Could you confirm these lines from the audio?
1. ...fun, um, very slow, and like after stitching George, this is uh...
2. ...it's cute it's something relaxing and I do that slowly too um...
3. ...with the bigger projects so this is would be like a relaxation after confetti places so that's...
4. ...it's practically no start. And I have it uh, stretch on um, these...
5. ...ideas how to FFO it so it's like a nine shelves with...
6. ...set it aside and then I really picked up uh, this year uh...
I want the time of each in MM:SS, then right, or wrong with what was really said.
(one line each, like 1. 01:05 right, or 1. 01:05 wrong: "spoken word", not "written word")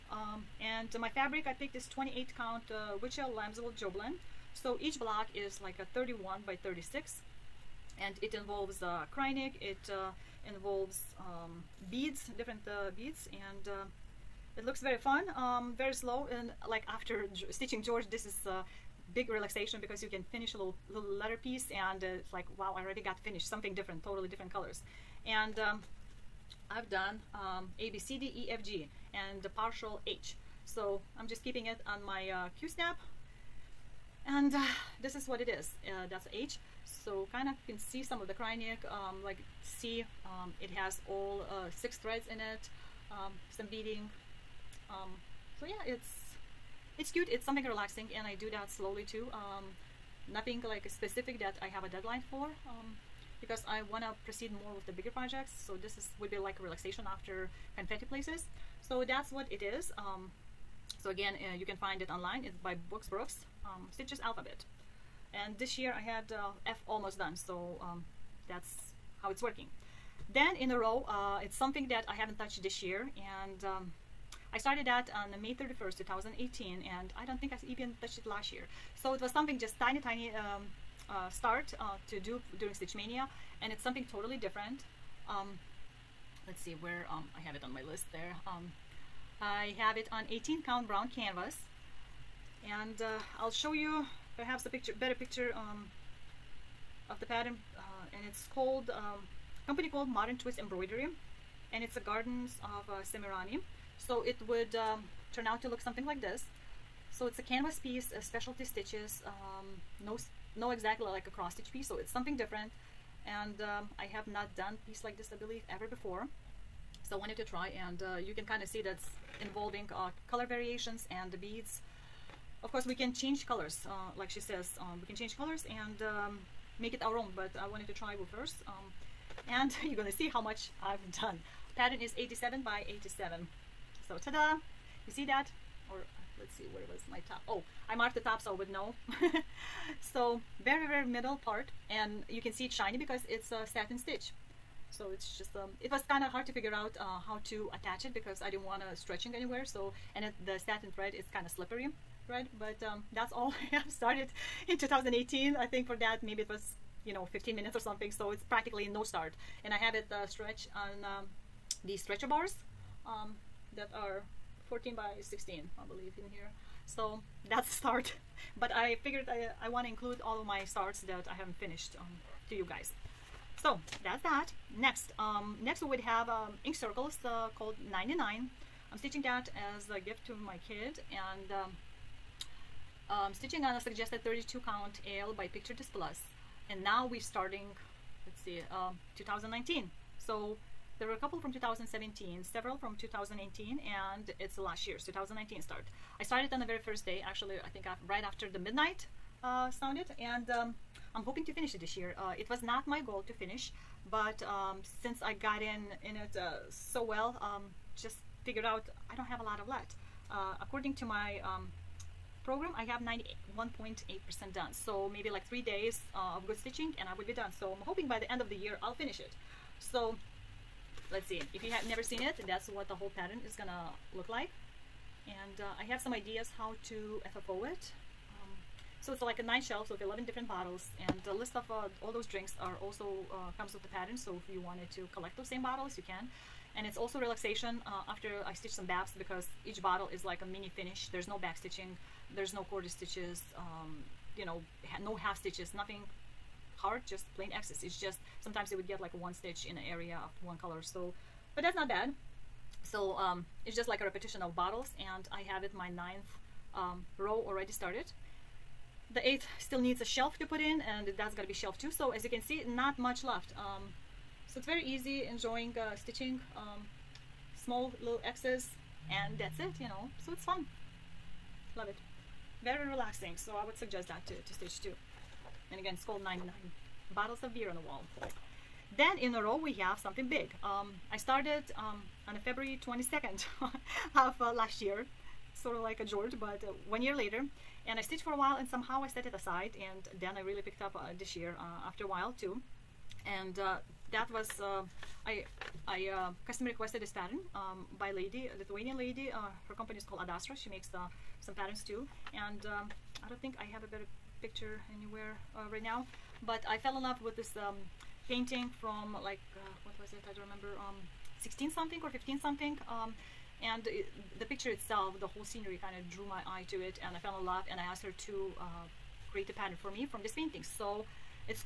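1. 00:14 right
2. 00:46 right
3. 00:54 right
4. 02:38 right
5. 03:46 right
6. 04:49 right.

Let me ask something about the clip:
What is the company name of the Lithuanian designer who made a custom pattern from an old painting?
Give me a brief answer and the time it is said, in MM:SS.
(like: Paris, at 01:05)
Adastra, at 05:00.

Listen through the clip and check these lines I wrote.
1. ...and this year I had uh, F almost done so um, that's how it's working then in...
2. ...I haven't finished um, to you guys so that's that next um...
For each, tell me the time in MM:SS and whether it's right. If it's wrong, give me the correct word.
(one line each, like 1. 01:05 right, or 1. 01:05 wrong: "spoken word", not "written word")
1. 01:05 right
2. 02:51 right.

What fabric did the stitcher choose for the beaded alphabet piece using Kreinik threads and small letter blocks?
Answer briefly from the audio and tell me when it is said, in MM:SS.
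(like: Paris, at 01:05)
28 count Wichelt Lambswool Jobelan, at 00:01.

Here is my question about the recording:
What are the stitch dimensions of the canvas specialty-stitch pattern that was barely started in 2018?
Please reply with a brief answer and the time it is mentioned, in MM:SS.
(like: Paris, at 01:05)
87 by 87, at 02:12.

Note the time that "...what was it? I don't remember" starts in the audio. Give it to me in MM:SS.
05:09.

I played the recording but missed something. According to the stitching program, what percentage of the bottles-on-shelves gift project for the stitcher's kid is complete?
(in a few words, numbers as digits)
91.8%.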